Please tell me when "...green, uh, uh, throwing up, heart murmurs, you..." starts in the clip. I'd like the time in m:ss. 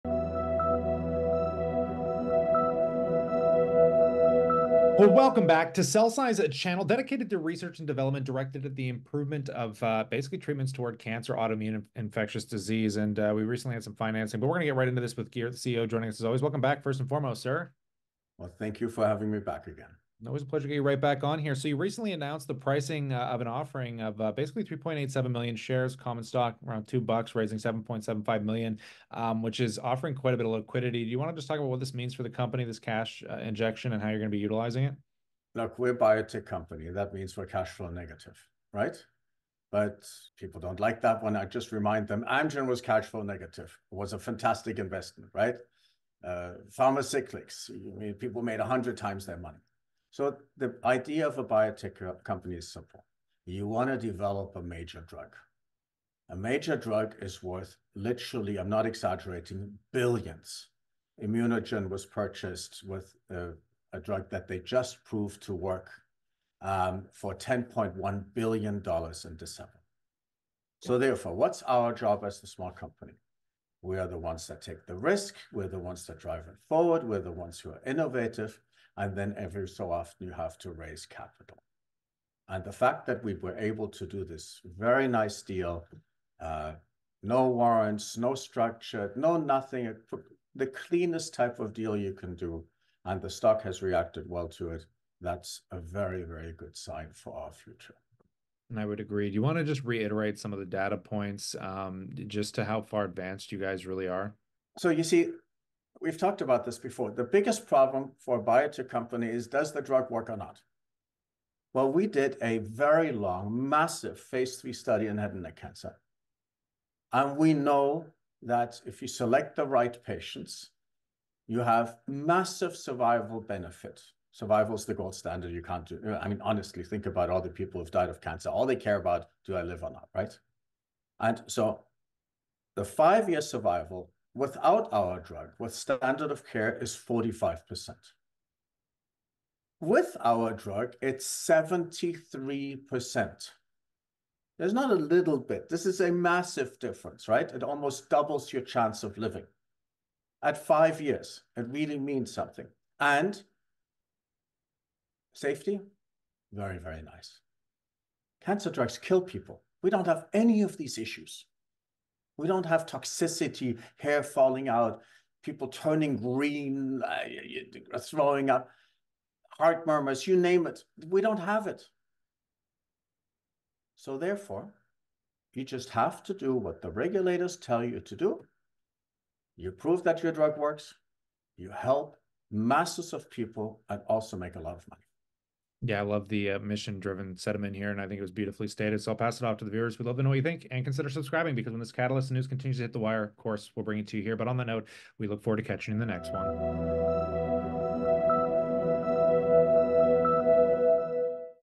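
2:46.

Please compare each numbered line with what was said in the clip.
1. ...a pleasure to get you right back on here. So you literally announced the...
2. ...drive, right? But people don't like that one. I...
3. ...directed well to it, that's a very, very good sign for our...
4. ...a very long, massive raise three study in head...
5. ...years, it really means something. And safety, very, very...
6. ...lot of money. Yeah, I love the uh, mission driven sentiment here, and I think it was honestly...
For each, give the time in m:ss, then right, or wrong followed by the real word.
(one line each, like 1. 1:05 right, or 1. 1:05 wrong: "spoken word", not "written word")
1. 0:20 wrong: "recently", not "literally"
2. 0:37 wrong: "negative", not "drive"
3. 1:33 wrong: "reacted", not "directed"
4. 1:52 wrong: "phase", not "raise"
5. 2:31 right
6. 3:04 wrong: "beautifully", not "honestly".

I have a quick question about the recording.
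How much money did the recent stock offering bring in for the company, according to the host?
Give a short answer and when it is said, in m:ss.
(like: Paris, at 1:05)
$7.75 million, at 0:27.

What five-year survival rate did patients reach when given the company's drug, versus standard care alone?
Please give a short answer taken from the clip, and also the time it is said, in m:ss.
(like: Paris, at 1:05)
73%, at 2:21.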